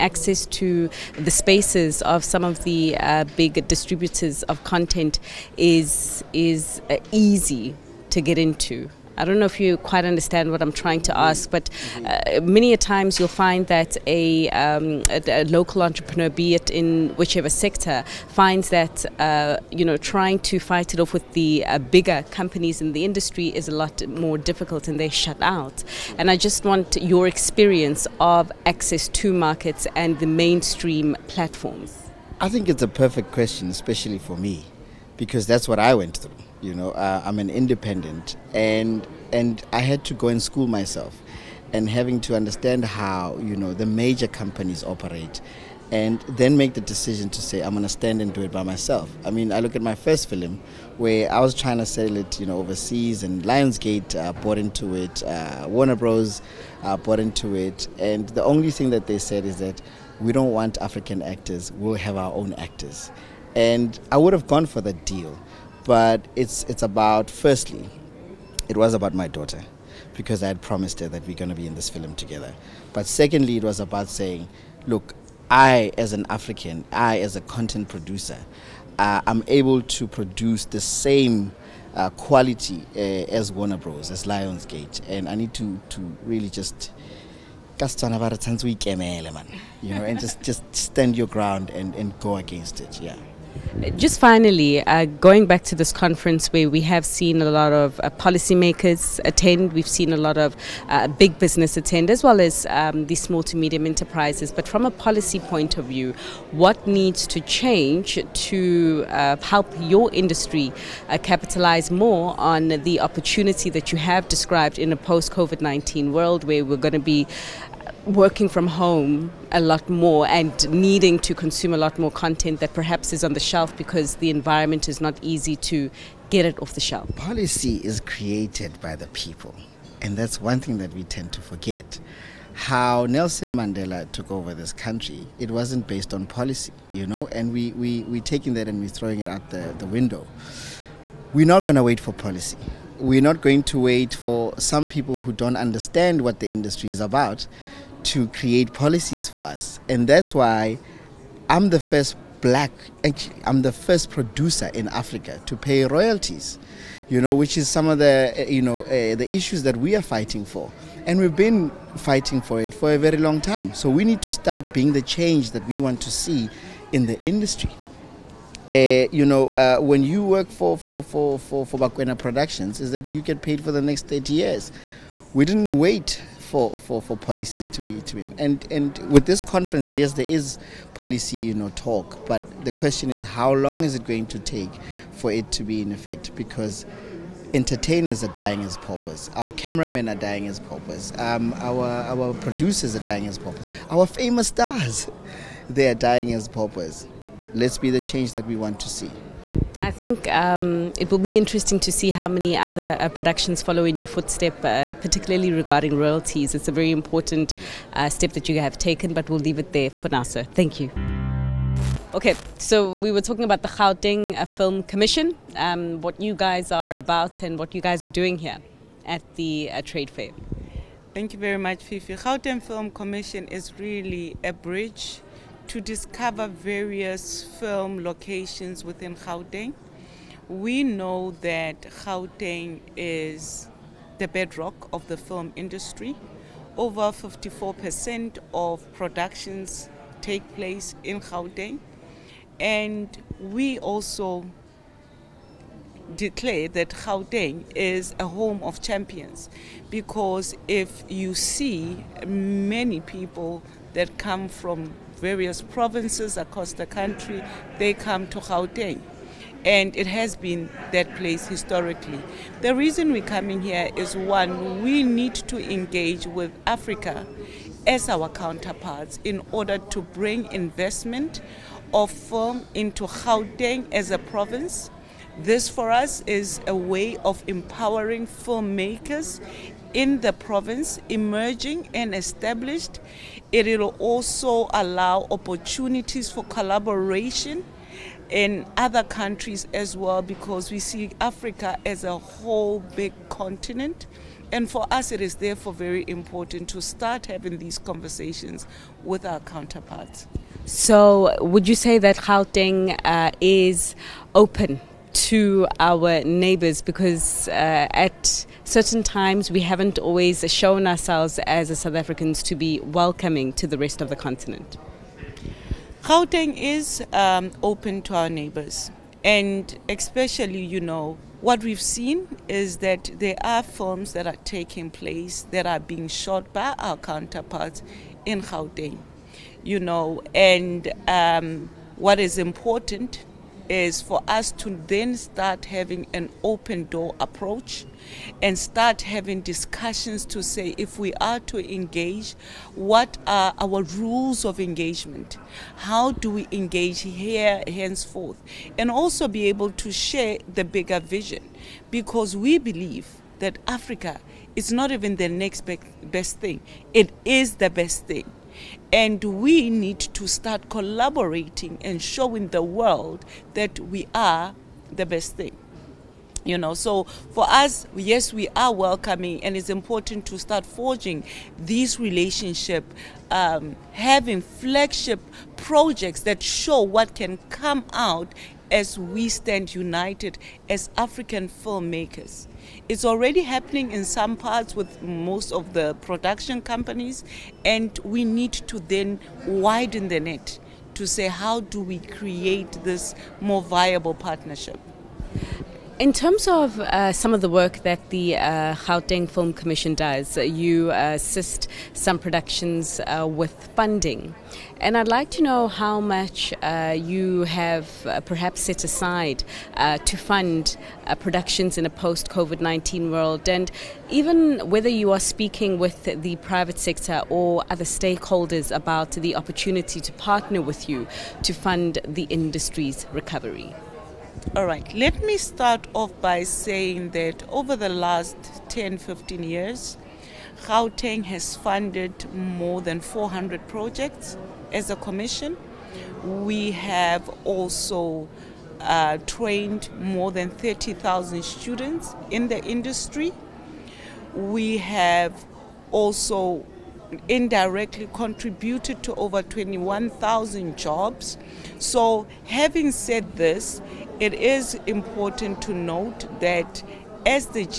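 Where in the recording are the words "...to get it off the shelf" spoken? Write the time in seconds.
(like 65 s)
125 s.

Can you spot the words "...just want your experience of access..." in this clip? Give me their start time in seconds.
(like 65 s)
26 s.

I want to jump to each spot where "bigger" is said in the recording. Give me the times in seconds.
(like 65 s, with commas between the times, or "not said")
21 s, 350 s.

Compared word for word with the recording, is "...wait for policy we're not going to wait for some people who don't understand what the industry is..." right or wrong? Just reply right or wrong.
right.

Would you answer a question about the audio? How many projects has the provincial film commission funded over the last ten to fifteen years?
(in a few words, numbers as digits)
400.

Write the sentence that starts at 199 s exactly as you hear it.
I think um, it will be interesting to see how many other uh, productions follow in your footstep, uh, particularly regarding royalties.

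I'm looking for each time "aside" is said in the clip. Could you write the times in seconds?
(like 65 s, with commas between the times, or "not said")
408 s.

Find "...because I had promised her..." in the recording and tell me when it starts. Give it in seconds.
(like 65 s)
70 s.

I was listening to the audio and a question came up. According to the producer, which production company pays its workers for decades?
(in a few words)
Bakwena Productions.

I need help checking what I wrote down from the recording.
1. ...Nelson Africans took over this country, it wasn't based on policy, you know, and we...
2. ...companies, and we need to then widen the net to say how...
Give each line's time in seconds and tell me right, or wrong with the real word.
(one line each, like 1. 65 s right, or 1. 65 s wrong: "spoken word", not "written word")
1. 133 s wrong: "Mandela", not "Africans"
2. 386 s right.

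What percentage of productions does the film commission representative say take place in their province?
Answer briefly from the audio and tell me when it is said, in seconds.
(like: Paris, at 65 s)
54%, at 237 s.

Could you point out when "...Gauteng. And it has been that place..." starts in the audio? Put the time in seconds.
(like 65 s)
258 s.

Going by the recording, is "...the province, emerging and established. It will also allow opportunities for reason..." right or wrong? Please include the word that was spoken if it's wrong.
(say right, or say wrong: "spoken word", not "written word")
wrong: "collaboration", not "reason".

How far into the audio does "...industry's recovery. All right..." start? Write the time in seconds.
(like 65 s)
422 s.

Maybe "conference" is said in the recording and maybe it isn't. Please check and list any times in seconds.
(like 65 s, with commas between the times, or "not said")
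95 s, 179 s.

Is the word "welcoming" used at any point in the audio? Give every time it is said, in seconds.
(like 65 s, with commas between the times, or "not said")
312 s, 368 s.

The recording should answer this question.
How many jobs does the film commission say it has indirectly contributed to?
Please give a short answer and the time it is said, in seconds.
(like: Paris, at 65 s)
21,000, at 449 s.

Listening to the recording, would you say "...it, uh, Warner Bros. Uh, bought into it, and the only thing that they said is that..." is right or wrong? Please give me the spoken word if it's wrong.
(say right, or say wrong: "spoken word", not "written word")
right.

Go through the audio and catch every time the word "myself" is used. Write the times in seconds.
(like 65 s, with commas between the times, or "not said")
40 s, 48 s.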